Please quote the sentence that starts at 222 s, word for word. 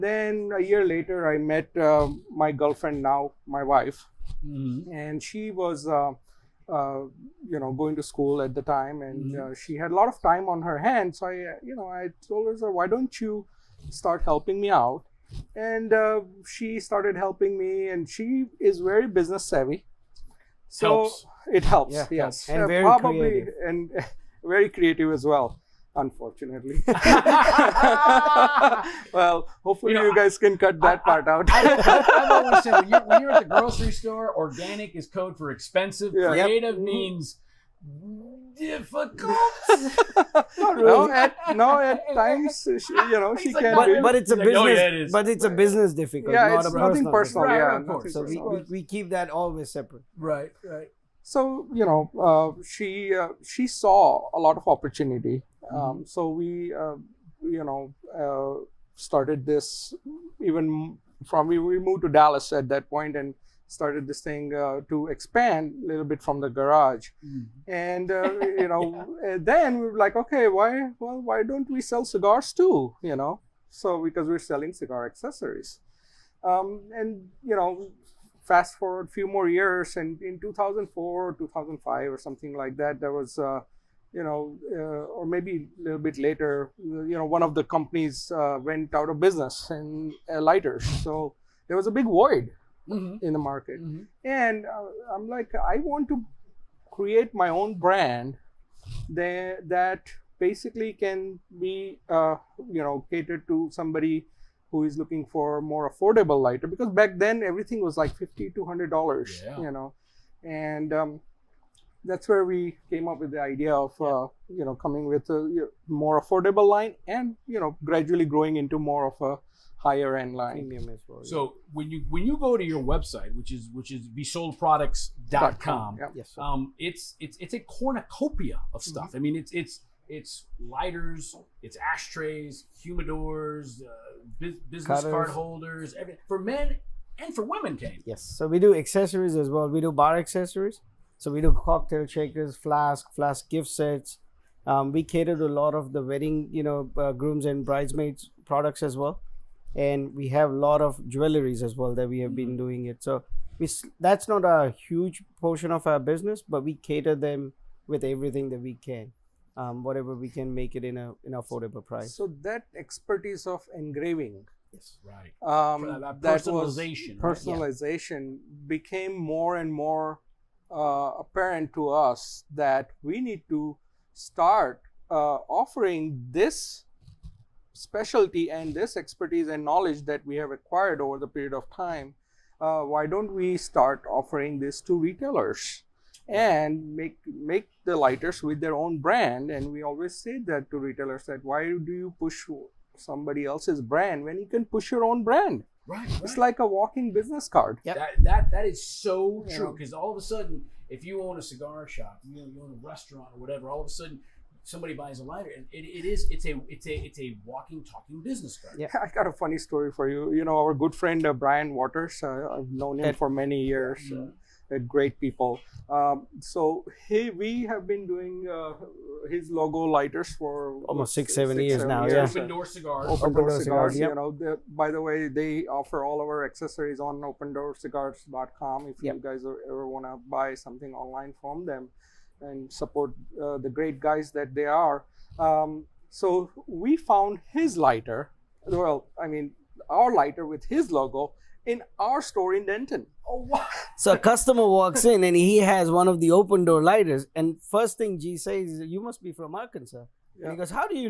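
yeah open door cigars open, open door, door, cigars, cigars yep.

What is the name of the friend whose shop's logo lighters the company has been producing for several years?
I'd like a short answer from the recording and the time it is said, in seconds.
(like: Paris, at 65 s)
Brian Waters, at 211 s.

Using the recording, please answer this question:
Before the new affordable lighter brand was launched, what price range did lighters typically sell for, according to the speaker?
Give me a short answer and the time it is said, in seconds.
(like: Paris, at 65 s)
50 to 100 dollars, at 108 s.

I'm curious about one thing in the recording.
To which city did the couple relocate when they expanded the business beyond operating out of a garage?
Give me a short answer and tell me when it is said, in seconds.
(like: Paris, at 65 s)
Dallas, at 62 s.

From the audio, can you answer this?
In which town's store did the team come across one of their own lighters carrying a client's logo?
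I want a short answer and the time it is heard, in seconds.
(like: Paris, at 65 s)
Denton, at 242 s.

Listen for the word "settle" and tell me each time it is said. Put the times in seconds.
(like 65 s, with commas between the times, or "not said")
not said.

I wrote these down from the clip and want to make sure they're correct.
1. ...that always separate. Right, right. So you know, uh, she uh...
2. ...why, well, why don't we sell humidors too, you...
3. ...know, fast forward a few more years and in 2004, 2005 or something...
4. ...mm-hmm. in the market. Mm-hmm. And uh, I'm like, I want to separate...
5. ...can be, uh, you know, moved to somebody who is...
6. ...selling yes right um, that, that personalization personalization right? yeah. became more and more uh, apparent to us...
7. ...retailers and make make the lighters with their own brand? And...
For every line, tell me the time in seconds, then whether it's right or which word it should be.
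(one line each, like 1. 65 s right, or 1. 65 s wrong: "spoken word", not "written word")
1. 49 s right
2. 70 s wrong: "cigars", not "humidors"
3. 77 s right
4. 92 s wrong: "create", not "separate"
5. 100 s wrong: "catered", not "moved"
6. 163 s wrong: "engraving", not "selling"
7. 184 s right.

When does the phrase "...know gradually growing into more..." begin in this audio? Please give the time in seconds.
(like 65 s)
117 s.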